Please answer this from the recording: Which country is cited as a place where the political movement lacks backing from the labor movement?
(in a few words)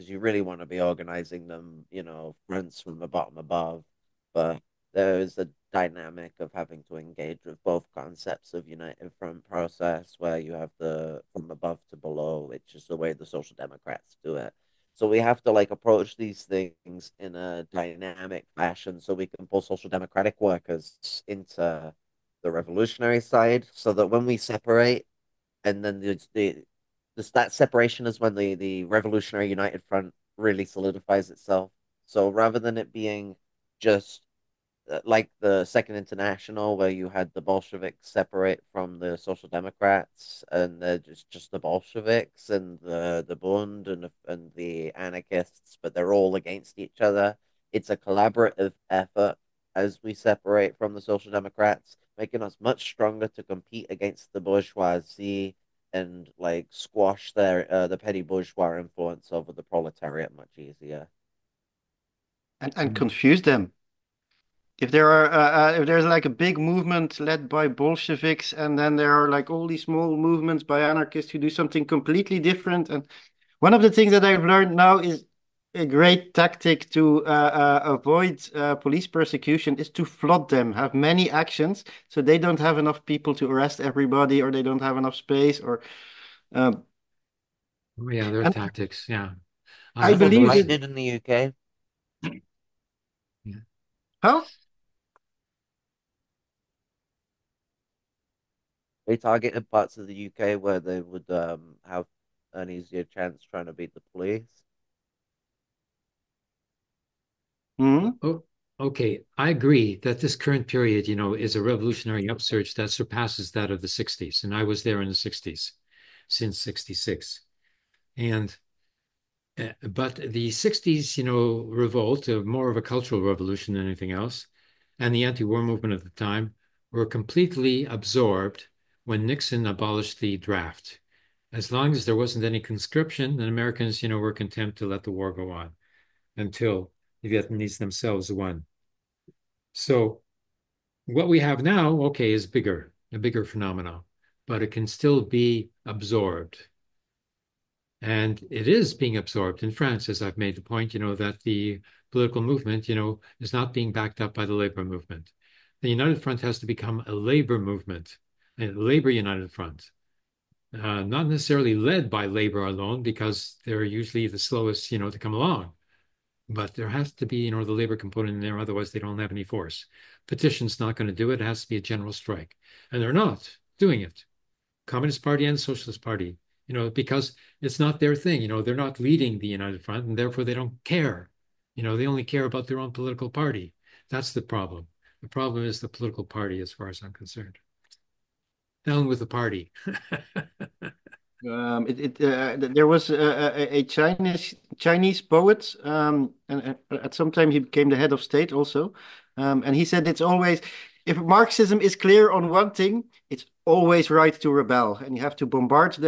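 France.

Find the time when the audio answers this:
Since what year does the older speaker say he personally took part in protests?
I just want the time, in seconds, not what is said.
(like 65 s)
116 s.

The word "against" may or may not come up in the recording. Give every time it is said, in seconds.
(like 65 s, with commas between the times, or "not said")
46 s, 53 s.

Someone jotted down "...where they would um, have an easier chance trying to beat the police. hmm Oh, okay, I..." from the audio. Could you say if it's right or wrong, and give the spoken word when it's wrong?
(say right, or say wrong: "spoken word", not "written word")
right.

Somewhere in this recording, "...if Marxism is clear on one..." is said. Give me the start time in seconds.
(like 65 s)
201 s.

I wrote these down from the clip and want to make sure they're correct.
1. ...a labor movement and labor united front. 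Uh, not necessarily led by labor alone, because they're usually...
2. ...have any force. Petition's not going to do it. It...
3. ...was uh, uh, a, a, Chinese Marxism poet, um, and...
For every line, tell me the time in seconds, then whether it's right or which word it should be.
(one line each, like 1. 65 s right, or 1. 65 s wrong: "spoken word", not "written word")
1. 157 s right
2. 169 s right
3. 192 s wrong: "Chinese", not "Marxism".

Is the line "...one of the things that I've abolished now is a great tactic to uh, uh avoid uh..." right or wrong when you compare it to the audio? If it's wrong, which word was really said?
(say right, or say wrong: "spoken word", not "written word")
wrong: "learned", not "abolished".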